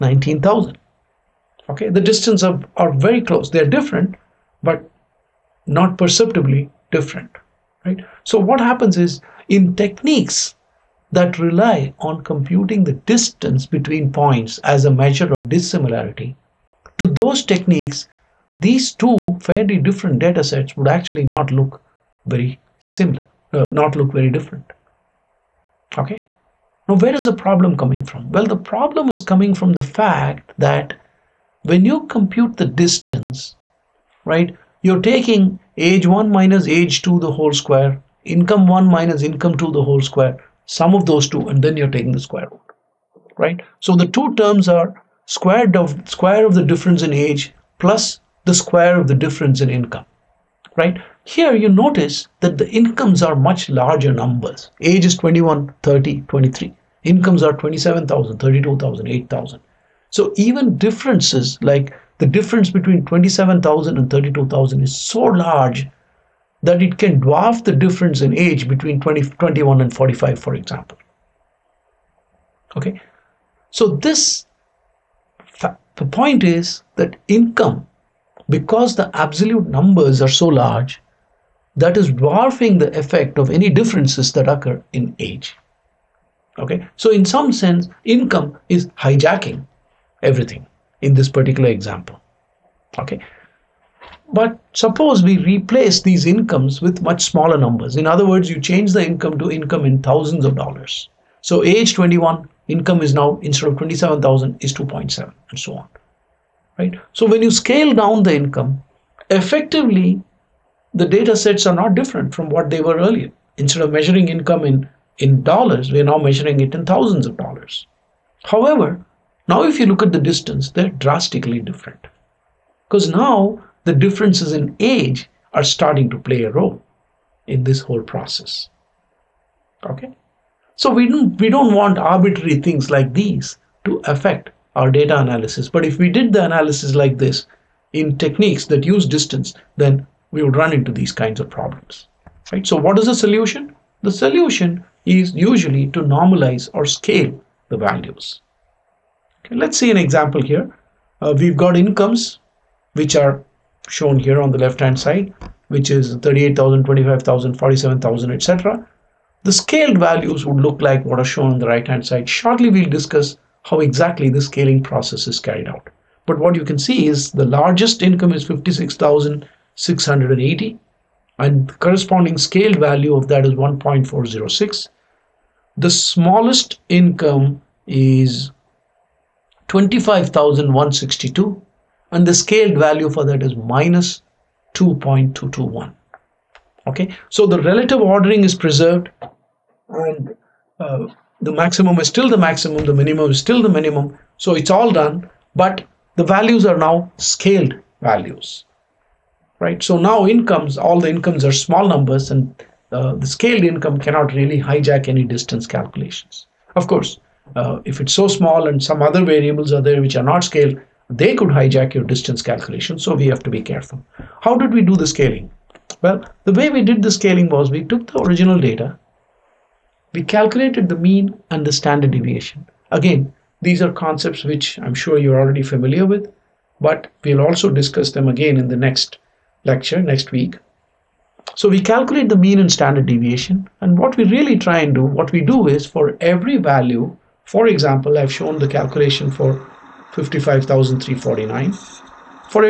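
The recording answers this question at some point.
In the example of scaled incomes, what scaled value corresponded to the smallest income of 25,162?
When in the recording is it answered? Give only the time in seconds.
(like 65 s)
183 s.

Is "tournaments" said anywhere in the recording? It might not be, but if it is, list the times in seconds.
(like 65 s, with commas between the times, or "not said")
not said.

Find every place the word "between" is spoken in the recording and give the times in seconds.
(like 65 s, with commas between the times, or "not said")
13 s, 62 s, 68 s.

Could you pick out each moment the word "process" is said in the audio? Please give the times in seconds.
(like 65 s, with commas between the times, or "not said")
128 s, 164 s.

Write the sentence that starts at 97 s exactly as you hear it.
In other words, you change the income to income in thousands of dollars.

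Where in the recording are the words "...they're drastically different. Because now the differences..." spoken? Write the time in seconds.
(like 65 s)
120 s.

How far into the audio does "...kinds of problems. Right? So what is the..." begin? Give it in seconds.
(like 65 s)
141 s.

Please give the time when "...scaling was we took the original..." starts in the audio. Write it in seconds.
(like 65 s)
217 s.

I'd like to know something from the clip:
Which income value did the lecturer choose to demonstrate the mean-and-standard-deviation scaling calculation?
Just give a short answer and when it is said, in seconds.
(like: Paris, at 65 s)
55,349, at 240 s.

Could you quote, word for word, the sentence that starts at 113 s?
Instead of measuring income in, in dollars, we're now measuring it in thousands of dollars.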